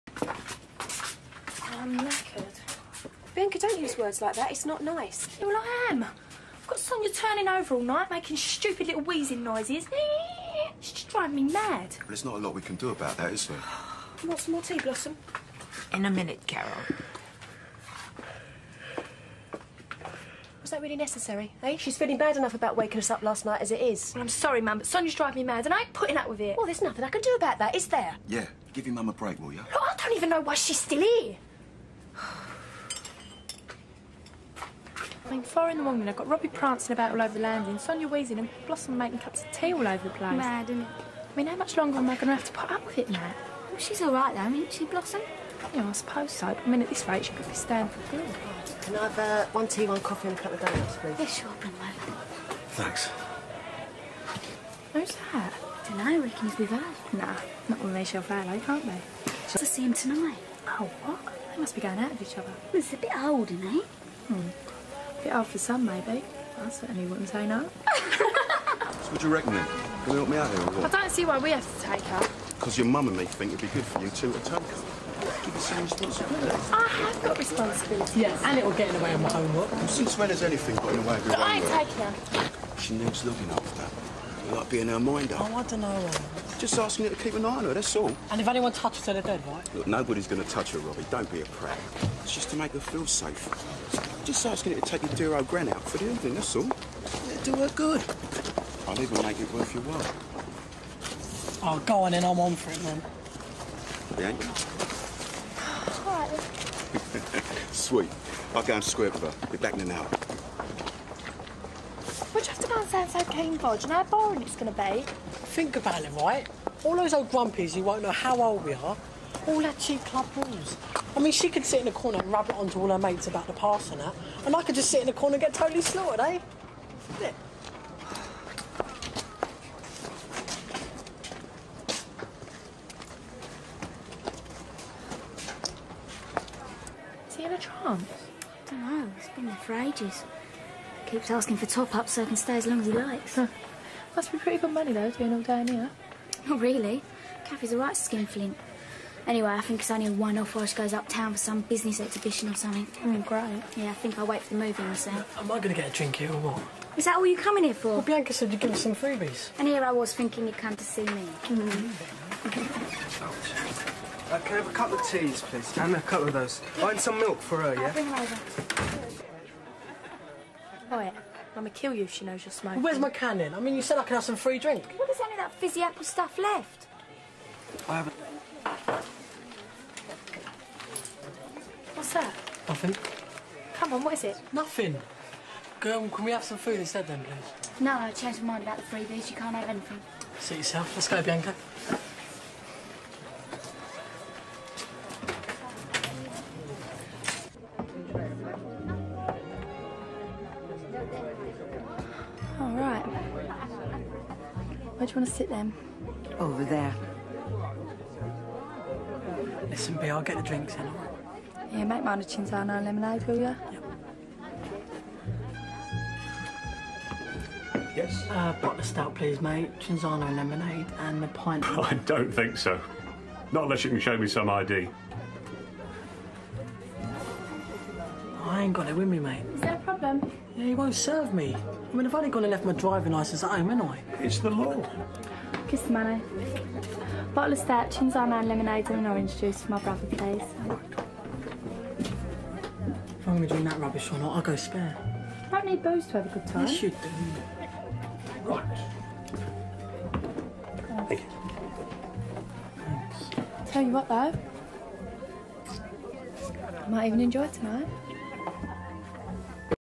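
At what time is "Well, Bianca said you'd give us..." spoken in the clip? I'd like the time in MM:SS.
02:37.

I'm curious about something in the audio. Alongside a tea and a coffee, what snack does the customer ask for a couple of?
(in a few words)
donuts.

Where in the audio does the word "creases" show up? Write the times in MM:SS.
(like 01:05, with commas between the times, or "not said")
not said.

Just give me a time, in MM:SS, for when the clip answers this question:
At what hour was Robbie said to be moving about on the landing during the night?
00:35.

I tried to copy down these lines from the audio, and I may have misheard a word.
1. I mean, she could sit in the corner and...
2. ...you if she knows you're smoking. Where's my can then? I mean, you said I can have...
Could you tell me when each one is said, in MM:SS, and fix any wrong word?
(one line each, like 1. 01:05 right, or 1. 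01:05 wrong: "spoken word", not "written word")
1. 02:01 right
2. 02:51 right.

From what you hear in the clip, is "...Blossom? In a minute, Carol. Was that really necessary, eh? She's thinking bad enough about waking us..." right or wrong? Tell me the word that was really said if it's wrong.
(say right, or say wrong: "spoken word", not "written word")
wrong: "feeling", not "thinking".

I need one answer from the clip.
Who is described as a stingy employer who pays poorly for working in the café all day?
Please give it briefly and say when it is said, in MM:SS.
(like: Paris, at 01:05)
Kathy, at 02:27.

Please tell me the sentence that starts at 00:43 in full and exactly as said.
Well, she's all right, though, isn't she, Blossom?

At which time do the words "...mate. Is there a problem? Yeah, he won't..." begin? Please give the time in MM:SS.
03:49.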